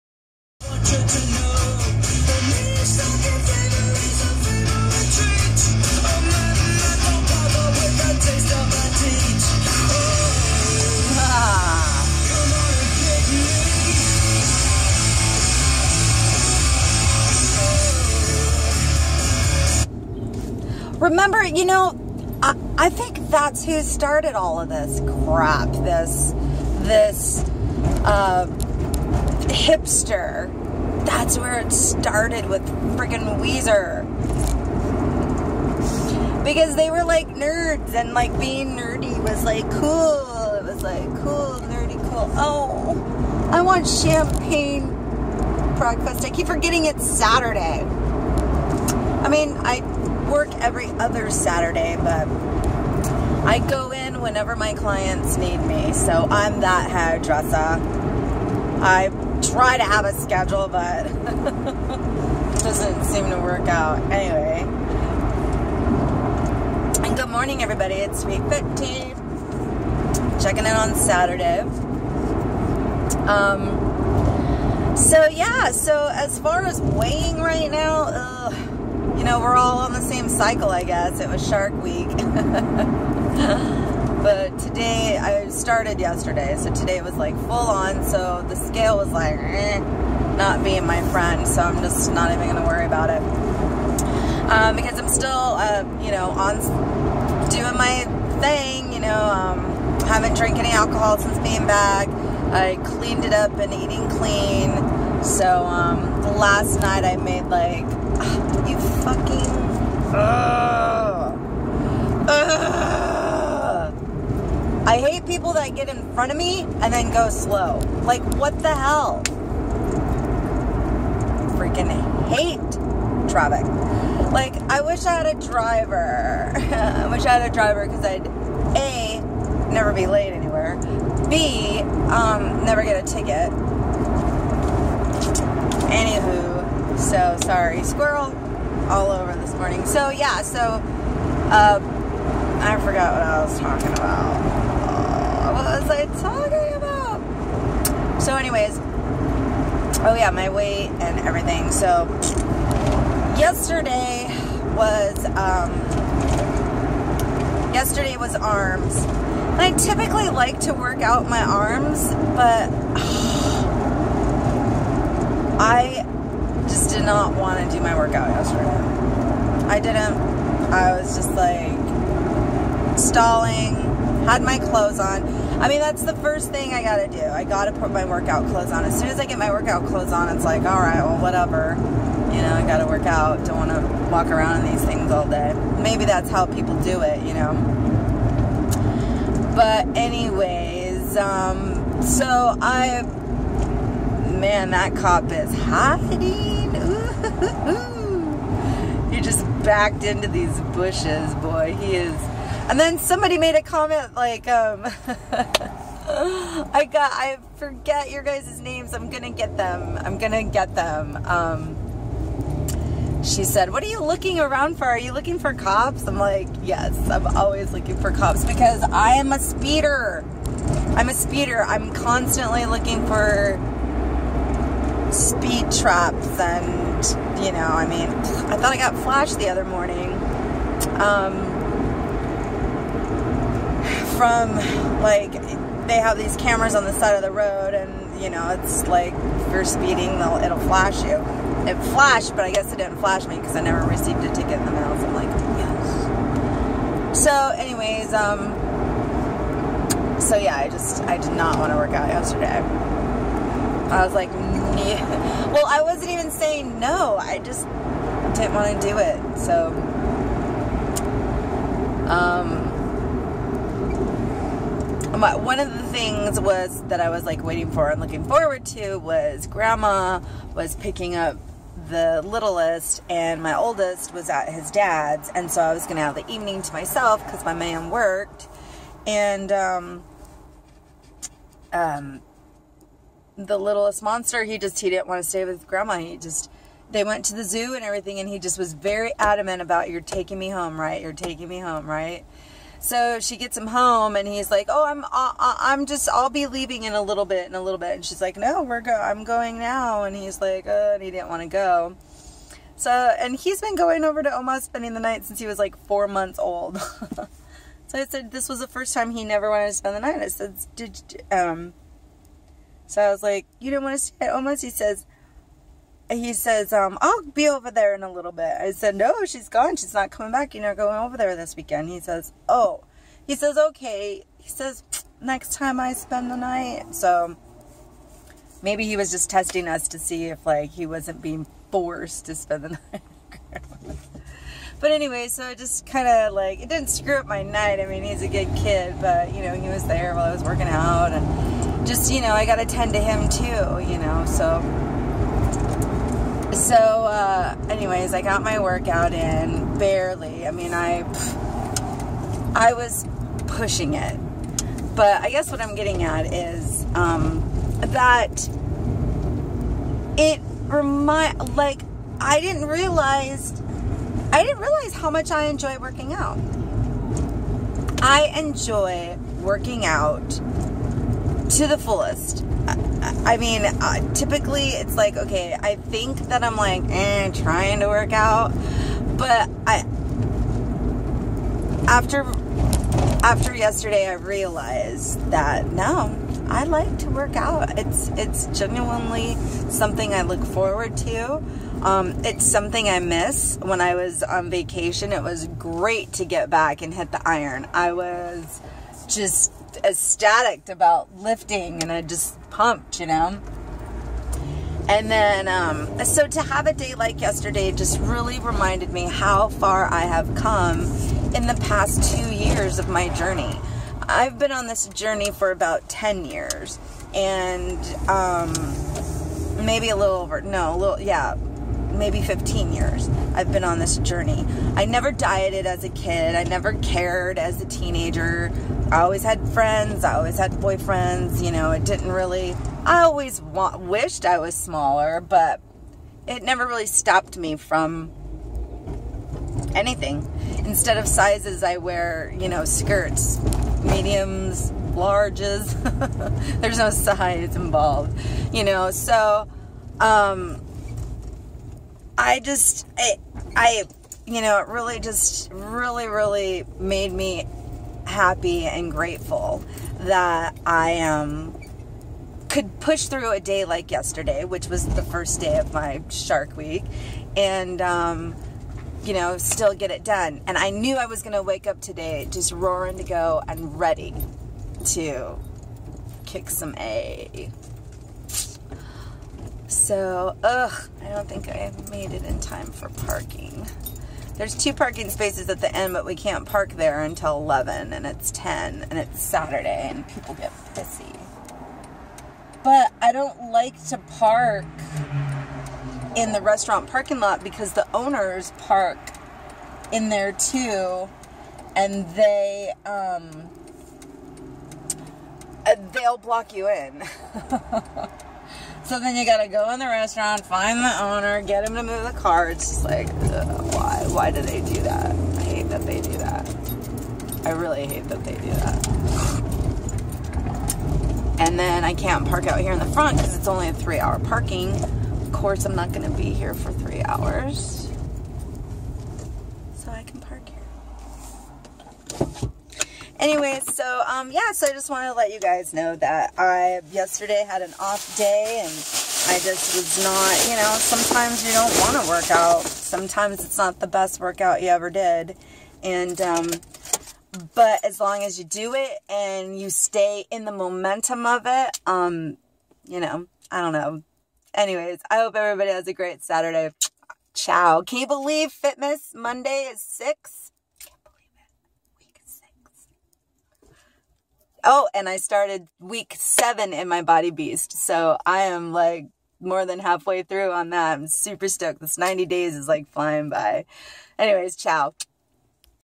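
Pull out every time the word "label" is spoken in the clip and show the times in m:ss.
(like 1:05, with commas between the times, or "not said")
not said.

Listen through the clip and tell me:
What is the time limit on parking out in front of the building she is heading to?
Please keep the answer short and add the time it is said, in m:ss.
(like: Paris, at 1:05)
3 hours, at 8:43.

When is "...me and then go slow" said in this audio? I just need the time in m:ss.
1:56.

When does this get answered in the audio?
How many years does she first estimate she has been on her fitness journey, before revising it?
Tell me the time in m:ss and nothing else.
6:55.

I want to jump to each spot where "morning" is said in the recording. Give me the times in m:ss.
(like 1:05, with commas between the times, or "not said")
1:07, 2:19, 3:49.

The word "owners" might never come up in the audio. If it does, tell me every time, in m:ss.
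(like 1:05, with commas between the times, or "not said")
8:17, 8:31.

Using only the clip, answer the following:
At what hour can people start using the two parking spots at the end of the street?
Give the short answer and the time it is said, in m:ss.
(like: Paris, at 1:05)
11, at 8:07.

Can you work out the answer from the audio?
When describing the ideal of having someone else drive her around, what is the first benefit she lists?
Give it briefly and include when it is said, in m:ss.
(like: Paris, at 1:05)
never be late anywhere, at 2:09.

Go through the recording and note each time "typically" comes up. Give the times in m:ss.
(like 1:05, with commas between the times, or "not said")
2:39, 6:14.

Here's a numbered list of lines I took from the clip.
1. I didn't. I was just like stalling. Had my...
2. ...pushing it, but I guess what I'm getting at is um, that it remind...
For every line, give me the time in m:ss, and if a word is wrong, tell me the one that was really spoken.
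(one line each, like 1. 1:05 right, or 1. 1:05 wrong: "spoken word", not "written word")
1. 2:49 right
2. 5:53 right.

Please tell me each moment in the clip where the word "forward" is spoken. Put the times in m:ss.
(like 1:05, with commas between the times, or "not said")
4:28, 6:30.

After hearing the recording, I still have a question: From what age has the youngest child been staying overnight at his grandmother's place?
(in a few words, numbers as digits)
4 months old.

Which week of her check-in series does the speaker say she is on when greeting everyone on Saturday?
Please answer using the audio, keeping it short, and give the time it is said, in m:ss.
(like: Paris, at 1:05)
15, at 1:08.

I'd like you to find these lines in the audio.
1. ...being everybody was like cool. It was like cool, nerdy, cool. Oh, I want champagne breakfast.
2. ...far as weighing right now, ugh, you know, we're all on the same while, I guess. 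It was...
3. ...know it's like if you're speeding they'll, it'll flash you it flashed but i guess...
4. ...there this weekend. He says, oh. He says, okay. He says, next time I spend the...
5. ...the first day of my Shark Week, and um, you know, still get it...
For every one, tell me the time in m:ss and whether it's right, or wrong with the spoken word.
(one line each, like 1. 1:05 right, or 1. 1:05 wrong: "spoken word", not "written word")
1. 0:38 wrong: "nerdy", not "everybody"
2. 1:16 wrong: "cycle", not "while"
3. 3:58 right
4. 5:21 right
5. 7:44 right.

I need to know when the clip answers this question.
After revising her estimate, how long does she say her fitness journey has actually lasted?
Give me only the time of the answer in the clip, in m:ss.
7:02.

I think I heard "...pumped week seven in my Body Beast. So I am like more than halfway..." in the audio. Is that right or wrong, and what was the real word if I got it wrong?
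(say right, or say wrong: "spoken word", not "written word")
wrong: "started", not "pumped".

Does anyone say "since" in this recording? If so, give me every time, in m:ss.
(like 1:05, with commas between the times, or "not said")
1:41, 5:05.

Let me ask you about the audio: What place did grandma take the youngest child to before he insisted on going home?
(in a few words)
the zoo.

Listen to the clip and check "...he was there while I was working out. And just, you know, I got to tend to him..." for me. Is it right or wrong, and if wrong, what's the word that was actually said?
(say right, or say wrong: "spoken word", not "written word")
right.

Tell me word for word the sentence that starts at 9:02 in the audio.
Sometimes it's not the best workout you ever did.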